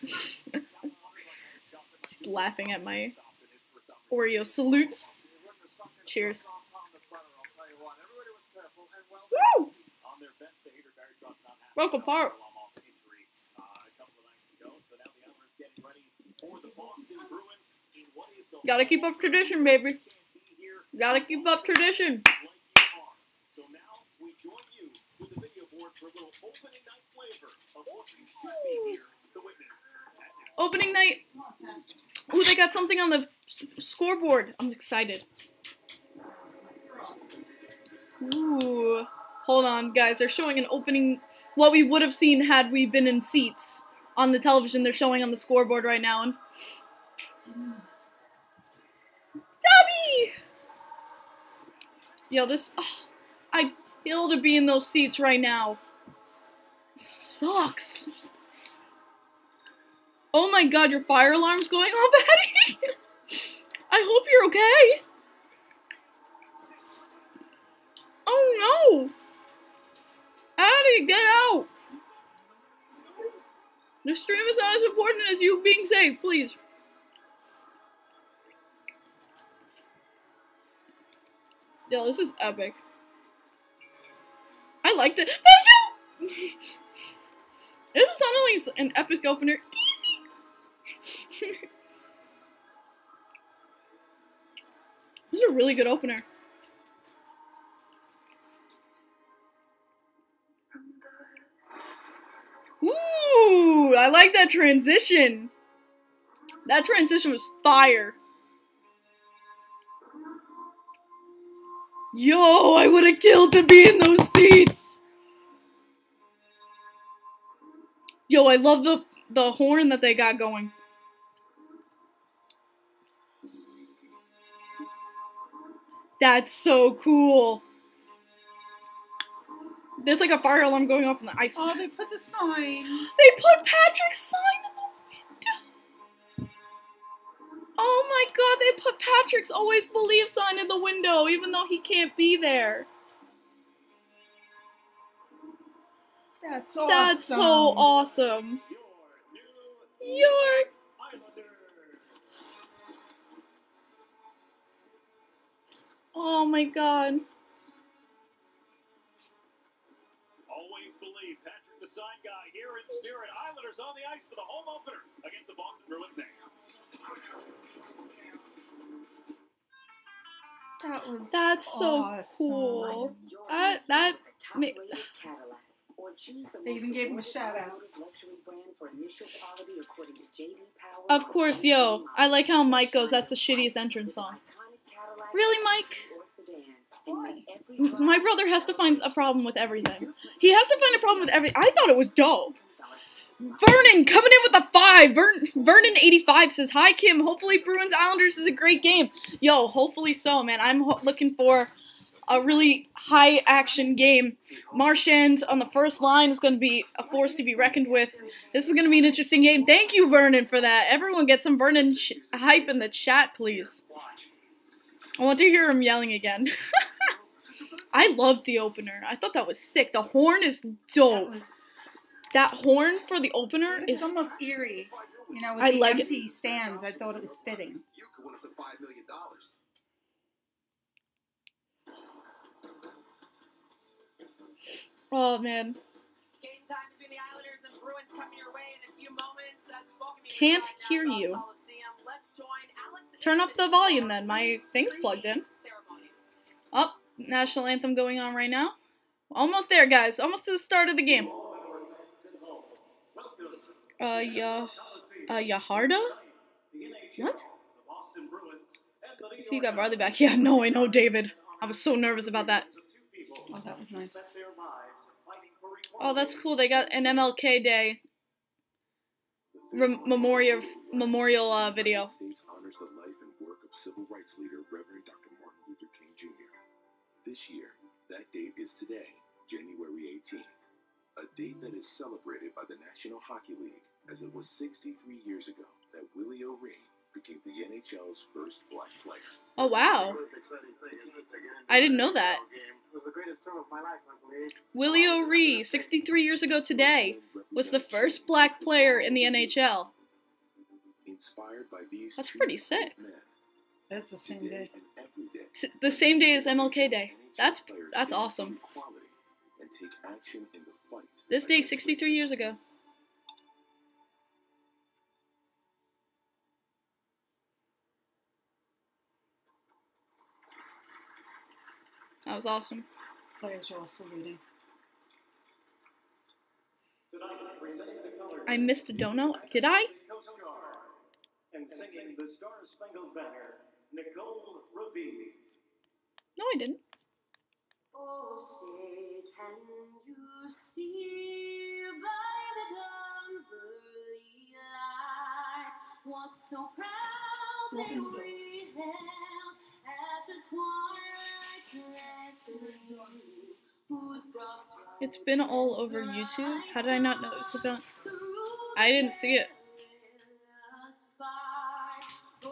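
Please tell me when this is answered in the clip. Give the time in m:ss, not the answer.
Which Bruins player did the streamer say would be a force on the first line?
3:24.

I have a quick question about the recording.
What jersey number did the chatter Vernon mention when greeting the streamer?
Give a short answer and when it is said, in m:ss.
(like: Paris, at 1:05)
85, at 3:16.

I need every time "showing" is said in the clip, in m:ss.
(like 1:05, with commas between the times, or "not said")
0:40, 0:44.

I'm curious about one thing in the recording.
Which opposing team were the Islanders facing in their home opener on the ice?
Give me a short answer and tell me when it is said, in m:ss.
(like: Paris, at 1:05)
Boston Bruins, at 2:45.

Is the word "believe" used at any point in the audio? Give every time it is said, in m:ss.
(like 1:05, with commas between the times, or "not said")
2:19, 2:41.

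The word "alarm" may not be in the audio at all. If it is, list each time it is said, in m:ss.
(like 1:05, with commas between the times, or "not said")
1:01, 2:10.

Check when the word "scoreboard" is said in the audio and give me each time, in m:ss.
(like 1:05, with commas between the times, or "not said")
0:33, 0:45.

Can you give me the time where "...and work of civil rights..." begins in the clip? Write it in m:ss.
4:33.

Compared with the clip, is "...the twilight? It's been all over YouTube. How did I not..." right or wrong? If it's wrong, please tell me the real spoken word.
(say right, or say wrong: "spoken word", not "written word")
right.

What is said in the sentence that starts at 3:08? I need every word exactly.
My brother has to find a problem with everything.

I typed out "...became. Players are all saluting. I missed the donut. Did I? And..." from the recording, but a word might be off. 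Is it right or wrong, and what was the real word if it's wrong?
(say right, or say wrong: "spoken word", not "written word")
wrong: "awesome", not "became".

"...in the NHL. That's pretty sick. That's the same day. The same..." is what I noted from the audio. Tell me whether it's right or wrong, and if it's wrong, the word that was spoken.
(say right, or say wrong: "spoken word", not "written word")
right.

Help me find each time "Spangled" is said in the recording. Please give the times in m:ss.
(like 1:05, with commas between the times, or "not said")
5:32.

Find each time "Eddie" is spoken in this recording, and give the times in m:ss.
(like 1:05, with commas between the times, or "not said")
1:02, 1:10.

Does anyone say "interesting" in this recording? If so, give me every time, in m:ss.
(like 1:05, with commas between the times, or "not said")
3:29.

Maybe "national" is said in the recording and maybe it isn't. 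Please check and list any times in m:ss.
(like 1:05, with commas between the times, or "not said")
4:07, 4:42.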